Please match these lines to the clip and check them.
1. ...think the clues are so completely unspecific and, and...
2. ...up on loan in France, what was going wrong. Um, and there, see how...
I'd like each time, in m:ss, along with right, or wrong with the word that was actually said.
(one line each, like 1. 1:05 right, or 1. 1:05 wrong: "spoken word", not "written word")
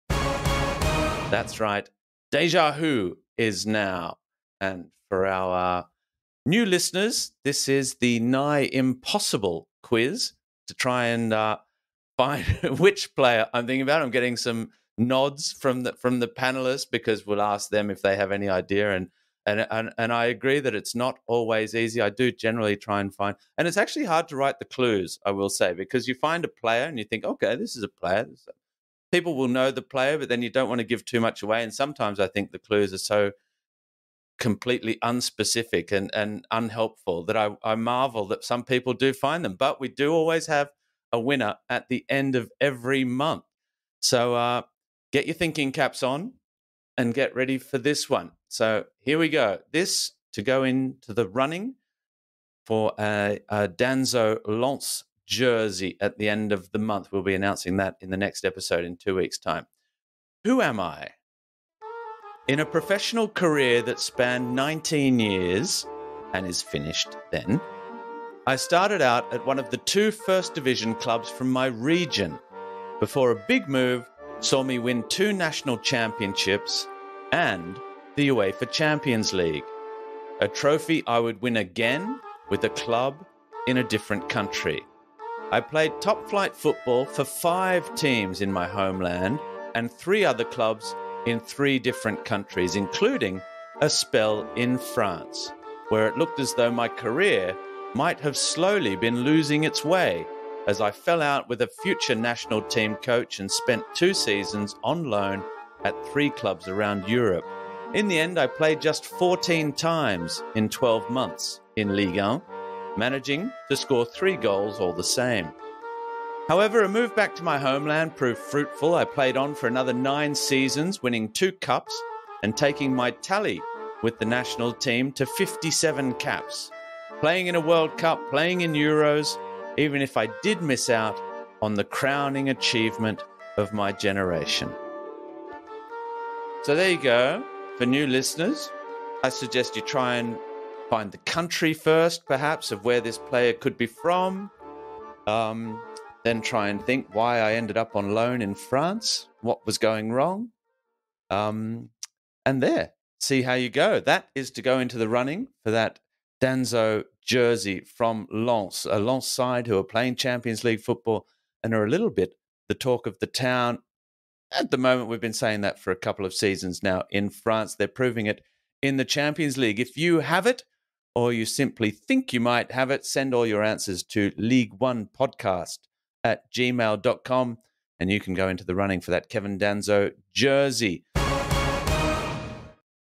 1. 0:32 right
2. 2:27 right.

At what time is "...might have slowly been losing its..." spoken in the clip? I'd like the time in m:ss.
1:37.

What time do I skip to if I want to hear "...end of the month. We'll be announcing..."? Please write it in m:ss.
0:56.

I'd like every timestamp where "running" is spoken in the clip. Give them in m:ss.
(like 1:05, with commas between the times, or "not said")
0:51, 2:35, 2:58.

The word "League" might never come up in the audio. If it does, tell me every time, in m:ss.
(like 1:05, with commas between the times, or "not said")
1:19, 2:40, 2:49.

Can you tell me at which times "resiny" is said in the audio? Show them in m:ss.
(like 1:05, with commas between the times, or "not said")
not said.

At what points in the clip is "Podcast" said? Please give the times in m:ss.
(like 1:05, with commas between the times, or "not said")
2:55.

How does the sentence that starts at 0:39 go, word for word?
But we do always have a winner at the end of every month.